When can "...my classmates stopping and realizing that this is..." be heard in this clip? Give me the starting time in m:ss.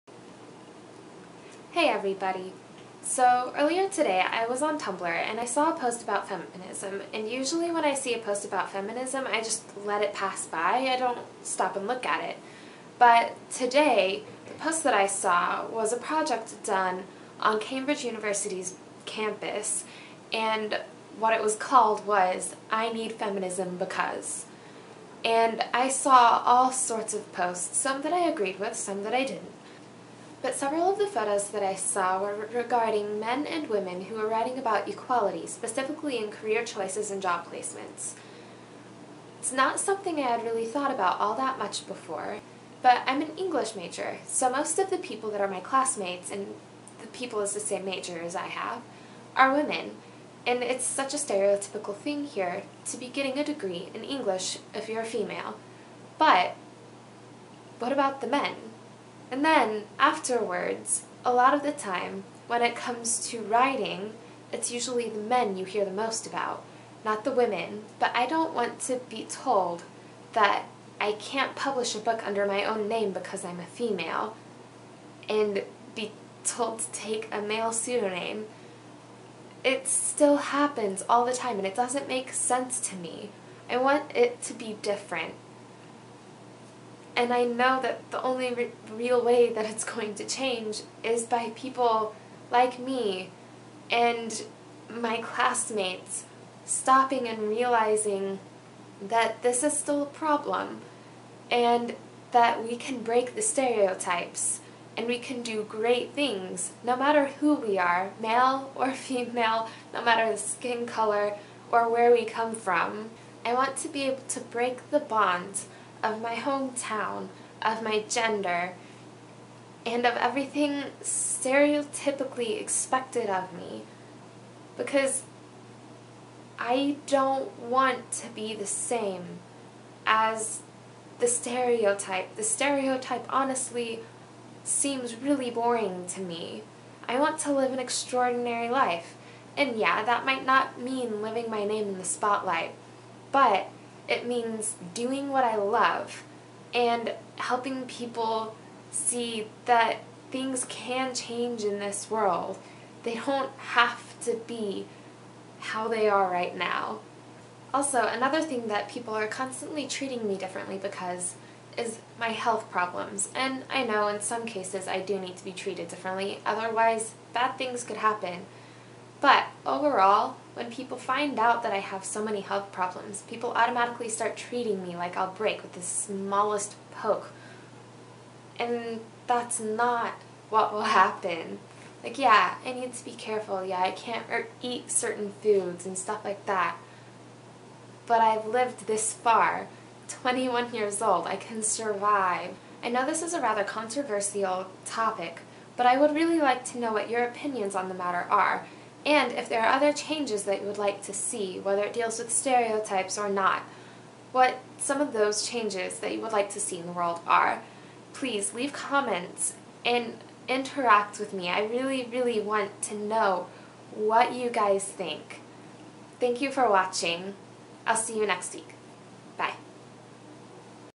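1:34.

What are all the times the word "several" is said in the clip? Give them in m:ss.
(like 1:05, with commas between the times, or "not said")
0:30.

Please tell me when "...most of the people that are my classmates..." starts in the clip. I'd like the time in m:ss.
0:44.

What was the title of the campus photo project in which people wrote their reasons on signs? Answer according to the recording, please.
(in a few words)
I Need Feminism Because.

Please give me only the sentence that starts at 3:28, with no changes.
Please leave comments and interact with me.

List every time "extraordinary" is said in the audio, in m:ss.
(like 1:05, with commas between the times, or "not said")
2:17.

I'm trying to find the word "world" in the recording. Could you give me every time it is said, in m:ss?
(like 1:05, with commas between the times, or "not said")
2:32, 3:26.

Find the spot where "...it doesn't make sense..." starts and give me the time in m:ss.
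1:21.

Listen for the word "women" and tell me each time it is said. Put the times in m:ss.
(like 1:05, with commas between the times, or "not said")
0:33, 0:49, 1:07.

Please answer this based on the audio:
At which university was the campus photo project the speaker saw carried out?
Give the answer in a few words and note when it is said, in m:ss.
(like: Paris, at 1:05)
Cambridge University, at 0:17.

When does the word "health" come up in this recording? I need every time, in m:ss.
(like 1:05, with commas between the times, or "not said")
2:42, 2:52.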